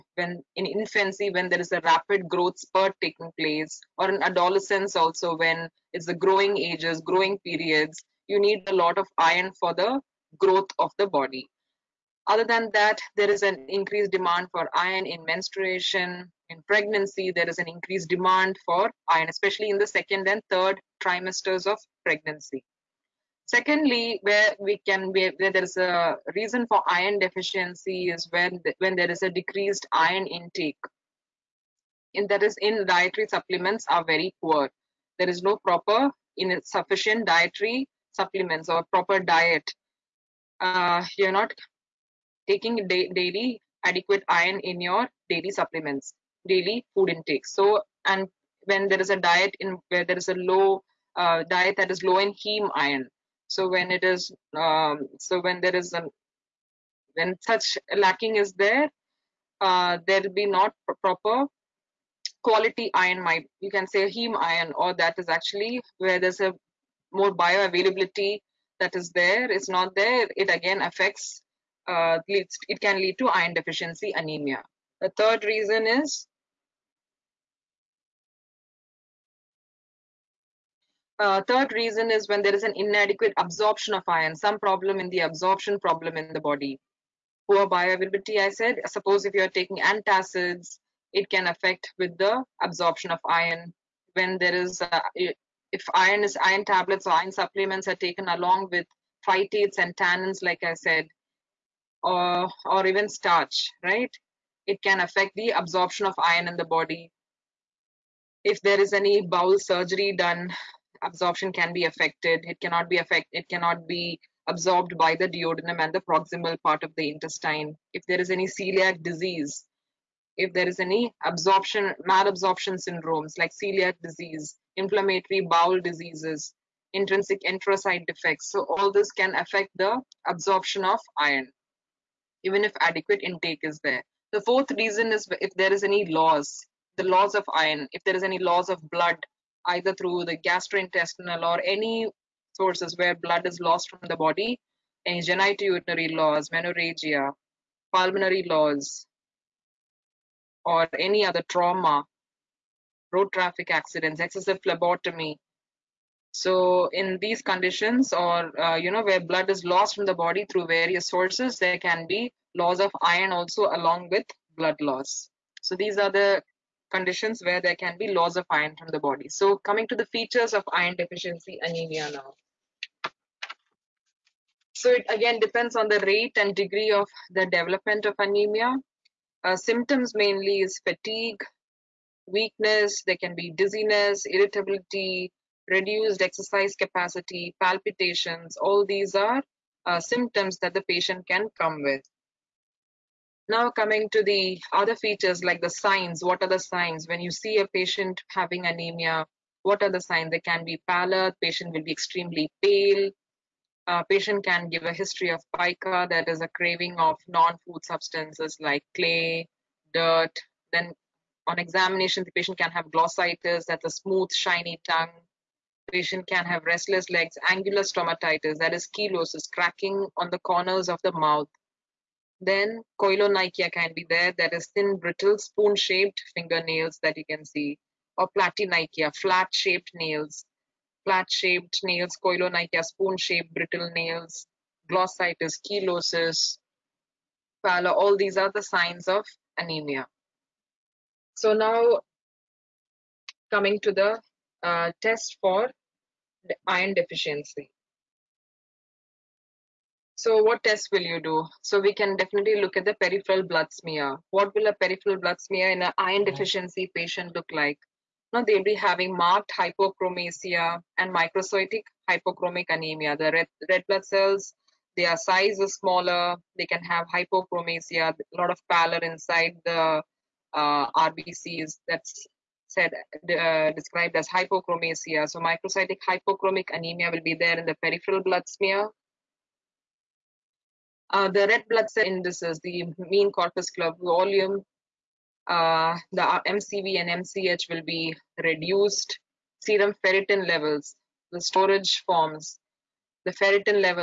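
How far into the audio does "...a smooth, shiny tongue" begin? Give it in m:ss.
3:33.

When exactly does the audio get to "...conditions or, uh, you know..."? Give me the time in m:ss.
2:37.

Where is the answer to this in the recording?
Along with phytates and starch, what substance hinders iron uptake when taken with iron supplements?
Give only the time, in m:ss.
1:39.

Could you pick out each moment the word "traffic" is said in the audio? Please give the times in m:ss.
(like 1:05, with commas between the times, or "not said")
2:33.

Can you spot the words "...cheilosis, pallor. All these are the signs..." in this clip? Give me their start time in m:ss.
3:55.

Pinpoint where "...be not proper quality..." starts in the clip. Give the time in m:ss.
1:00.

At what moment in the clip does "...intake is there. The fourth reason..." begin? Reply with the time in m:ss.
2:13.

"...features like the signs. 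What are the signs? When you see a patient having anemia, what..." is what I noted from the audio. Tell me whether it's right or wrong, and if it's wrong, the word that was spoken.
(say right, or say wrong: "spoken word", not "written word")
right.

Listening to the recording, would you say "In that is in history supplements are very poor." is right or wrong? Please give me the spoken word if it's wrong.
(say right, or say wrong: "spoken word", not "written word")
wrong: "dietary", not "history".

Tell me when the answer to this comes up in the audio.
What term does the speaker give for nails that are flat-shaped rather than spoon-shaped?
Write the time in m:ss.
3:48.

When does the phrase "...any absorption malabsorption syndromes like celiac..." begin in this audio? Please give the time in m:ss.
2:00.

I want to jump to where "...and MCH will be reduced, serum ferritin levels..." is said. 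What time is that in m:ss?
4:47.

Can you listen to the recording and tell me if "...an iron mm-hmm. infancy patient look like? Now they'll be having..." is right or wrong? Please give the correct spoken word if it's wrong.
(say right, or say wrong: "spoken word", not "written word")
wrong: "deficiency", not "infancy".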